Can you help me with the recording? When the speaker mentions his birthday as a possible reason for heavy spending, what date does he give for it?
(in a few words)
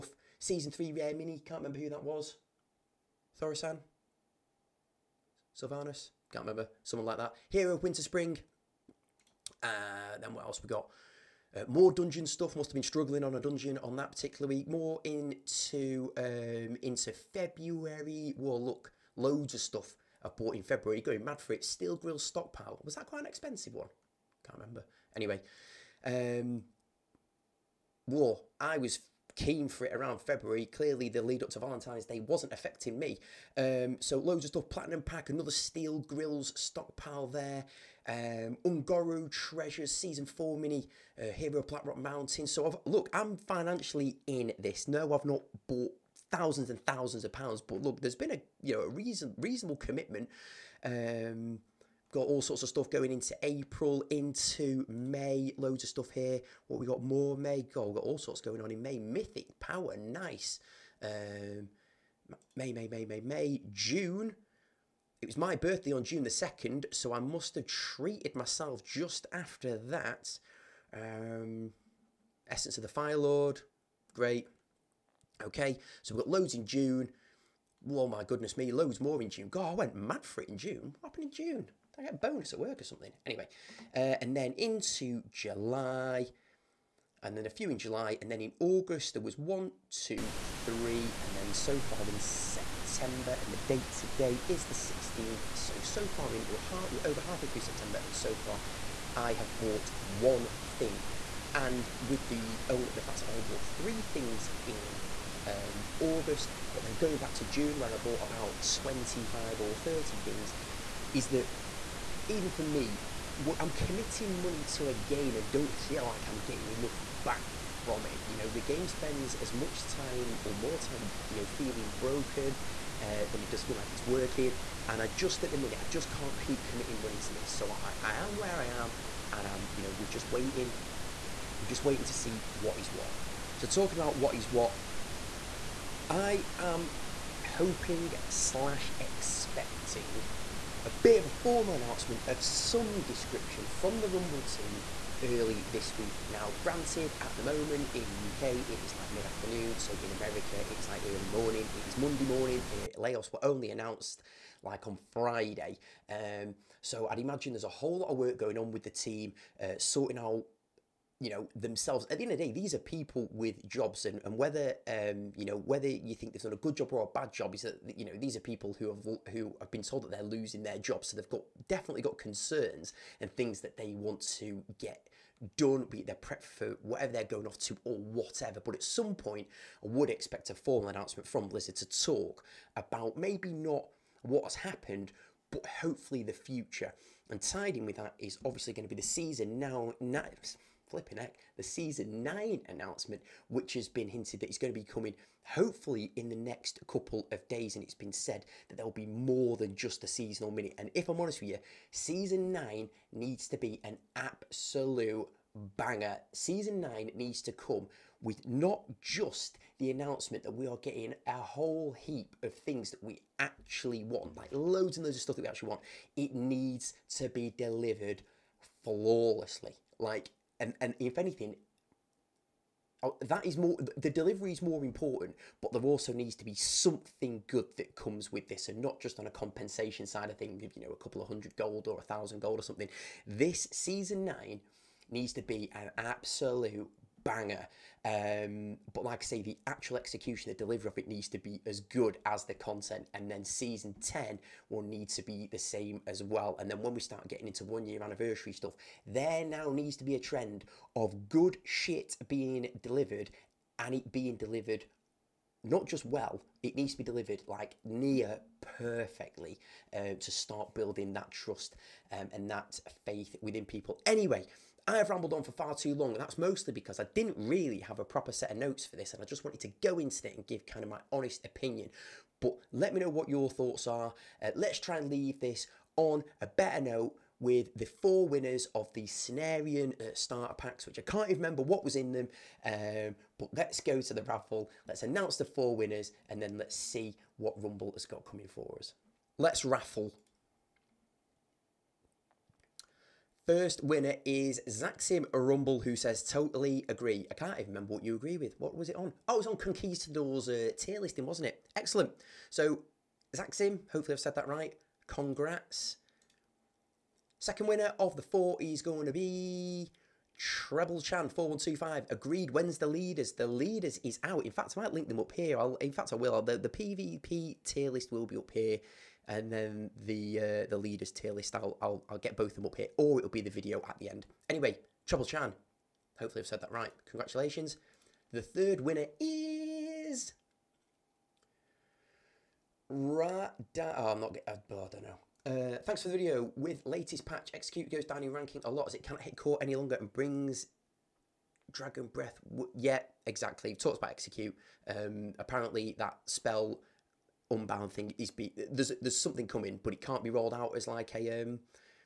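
June 2.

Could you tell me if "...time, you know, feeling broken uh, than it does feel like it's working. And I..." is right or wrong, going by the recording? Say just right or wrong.
right.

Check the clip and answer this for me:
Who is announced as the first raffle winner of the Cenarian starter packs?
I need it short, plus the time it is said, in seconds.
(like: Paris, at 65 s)
Zaxim Rumble, at 294 s.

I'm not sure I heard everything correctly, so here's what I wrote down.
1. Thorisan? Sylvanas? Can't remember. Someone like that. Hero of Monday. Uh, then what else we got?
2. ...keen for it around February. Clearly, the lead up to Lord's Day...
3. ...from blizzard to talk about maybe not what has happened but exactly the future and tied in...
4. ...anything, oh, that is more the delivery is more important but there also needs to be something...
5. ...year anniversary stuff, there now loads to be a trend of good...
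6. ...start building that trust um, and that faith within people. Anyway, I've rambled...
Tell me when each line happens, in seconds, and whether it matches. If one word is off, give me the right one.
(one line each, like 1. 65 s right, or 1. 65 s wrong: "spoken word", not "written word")
1. 3 s wrong: "Winterspring", not "Monday"
2. 29 s wrong: "Valentine", not "Lord"
3. 181 s wrong: "hopefully", not "exactly"
4. 221 s right
5. 247 s wrong: "needs", not "loads"
6. 260 s right.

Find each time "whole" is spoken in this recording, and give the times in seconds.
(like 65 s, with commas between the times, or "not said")
157 s, 211 s.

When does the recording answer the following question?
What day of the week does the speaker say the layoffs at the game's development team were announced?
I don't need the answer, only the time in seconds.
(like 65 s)
155 s.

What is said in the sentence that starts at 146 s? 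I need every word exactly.
Now, granted, at the moment in the UK, it is like mid afternoon.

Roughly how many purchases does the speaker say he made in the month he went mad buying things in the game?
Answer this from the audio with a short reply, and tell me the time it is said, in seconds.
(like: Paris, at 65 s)
25 or 30, at 108 s.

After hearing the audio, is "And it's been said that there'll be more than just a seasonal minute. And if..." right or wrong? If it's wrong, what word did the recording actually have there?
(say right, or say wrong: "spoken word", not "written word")
right.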